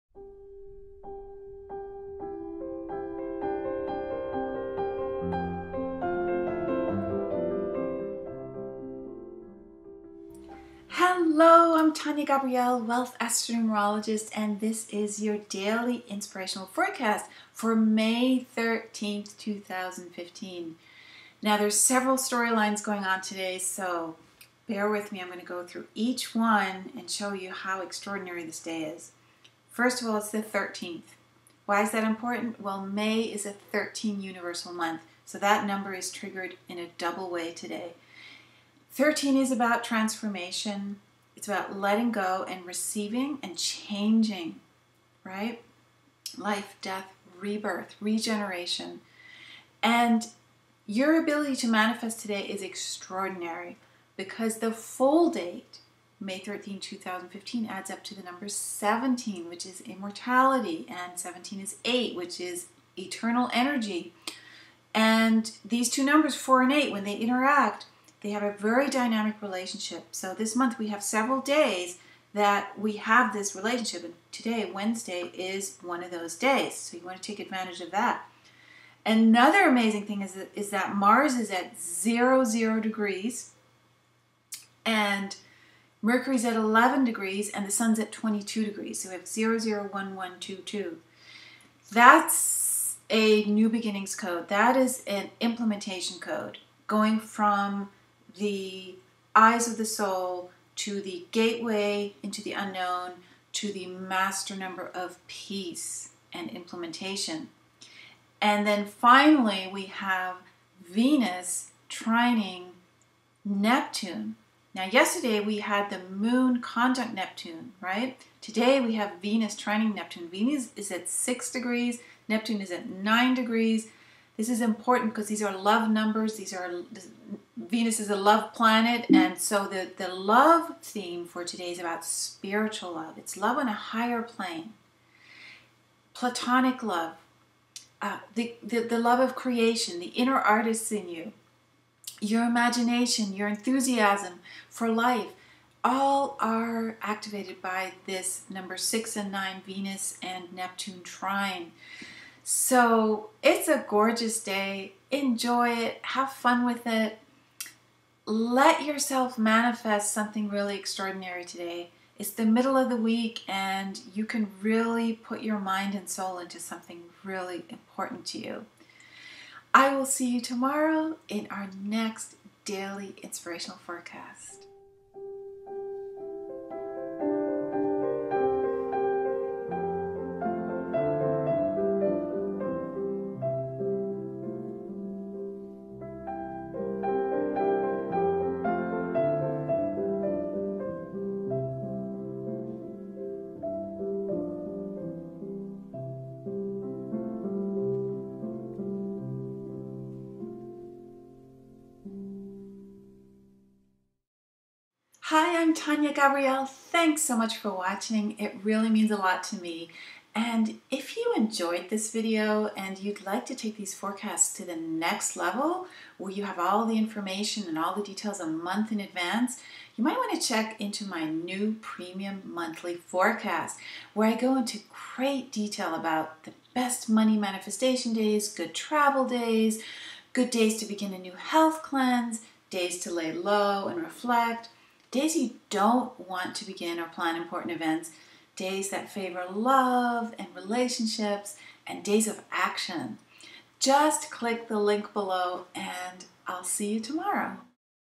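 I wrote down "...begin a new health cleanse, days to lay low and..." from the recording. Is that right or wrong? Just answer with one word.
right.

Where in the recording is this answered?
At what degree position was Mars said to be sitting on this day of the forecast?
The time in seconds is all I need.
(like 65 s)
81 s.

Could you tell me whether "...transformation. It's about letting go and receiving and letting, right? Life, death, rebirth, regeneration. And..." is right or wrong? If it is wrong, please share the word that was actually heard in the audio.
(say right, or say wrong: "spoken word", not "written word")
wrong: "changing", not "letting".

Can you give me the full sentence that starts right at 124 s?
This is important because these are love numbers.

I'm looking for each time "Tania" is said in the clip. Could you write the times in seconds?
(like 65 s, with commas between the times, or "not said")
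11 s, 205 s.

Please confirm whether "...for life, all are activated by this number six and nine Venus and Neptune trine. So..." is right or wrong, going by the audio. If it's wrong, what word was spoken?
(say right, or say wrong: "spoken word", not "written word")
right.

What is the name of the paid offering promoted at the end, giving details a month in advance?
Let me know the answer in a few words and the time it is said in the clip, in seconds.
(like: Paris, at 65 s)
premium monthly forecast, at 221 s.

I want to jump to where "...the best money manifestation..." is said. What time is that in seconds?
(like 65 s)
226 s.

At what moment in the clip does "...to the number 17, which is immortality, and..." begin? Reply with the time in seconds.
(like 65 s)
58 s.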